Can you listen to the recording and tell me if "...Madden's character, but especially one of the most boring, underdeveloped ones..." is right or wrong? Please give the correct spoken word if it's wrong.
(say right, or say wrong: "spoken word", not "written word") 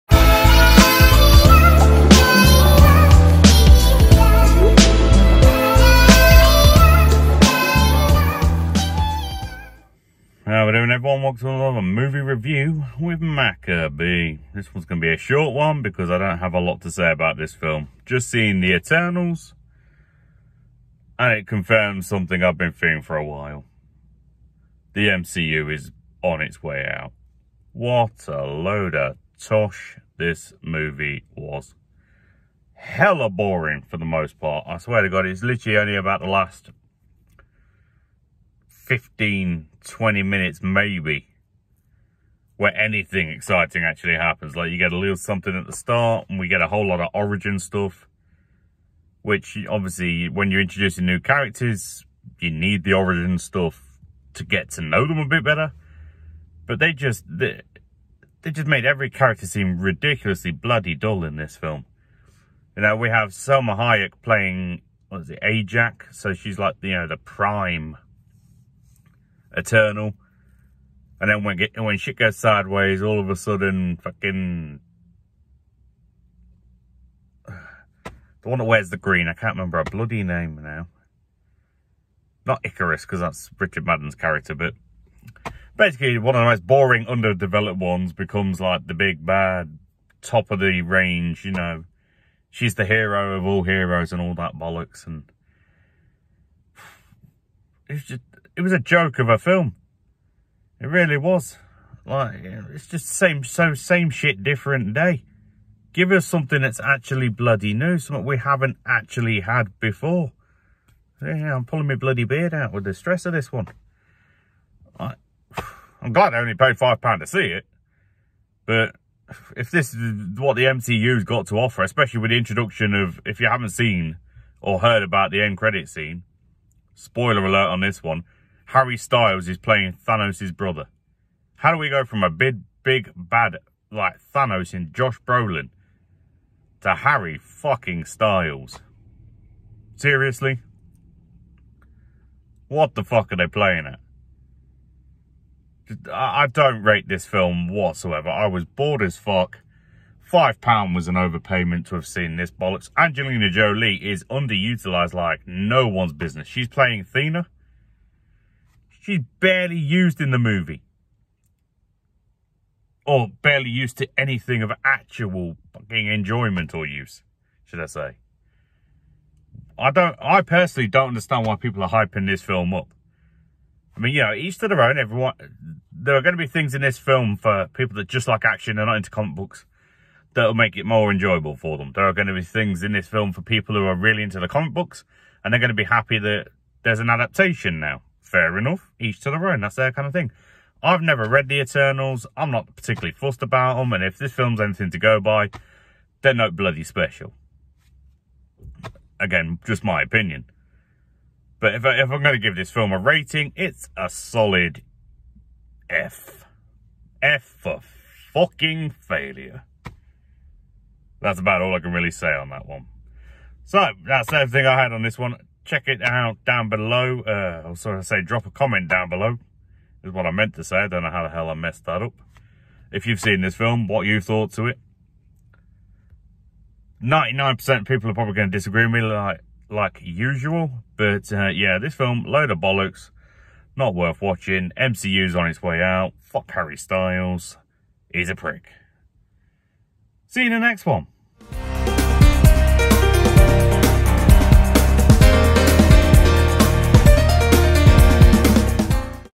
wrong: "basically", not "especially".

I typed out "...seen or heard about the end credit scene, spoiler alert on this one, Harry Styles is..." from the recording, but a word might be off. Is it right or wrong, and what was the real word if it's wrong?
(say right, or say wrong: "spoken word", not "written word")
right.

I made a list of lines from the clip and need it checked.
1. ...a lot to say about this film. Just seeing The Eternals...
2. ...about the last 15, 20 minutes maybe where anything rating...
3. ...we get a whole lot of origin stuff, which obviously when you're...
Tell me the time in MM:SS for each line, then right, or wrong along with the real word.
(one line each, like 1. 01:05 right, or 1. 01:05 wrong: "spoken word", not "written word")
1. 00:16 right
2. 00:35 wrong: "exciting", not "rating"
3. 00:46 right.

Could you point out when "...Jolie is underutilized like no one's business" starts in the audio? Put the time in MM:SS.
02:33.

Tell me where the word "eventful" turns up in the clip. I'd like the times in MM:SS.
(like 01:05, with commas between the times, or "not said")
not said.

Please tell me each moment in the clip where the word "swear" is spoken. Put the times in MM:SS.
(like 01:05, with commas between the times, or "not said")
00:34.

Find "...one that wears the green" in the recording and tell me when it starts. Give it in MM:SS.
01:18.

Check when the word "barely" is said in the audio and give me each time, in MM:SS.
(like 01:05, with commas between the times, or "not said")
02:39, 02:43.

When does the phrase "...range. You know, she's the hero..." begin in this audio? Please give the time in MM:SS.
01:30.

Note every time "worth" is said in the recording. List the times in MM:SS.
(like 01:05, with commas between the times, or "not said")
03:53.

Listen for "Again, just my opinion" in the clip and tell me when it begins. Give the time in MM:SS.
03:19.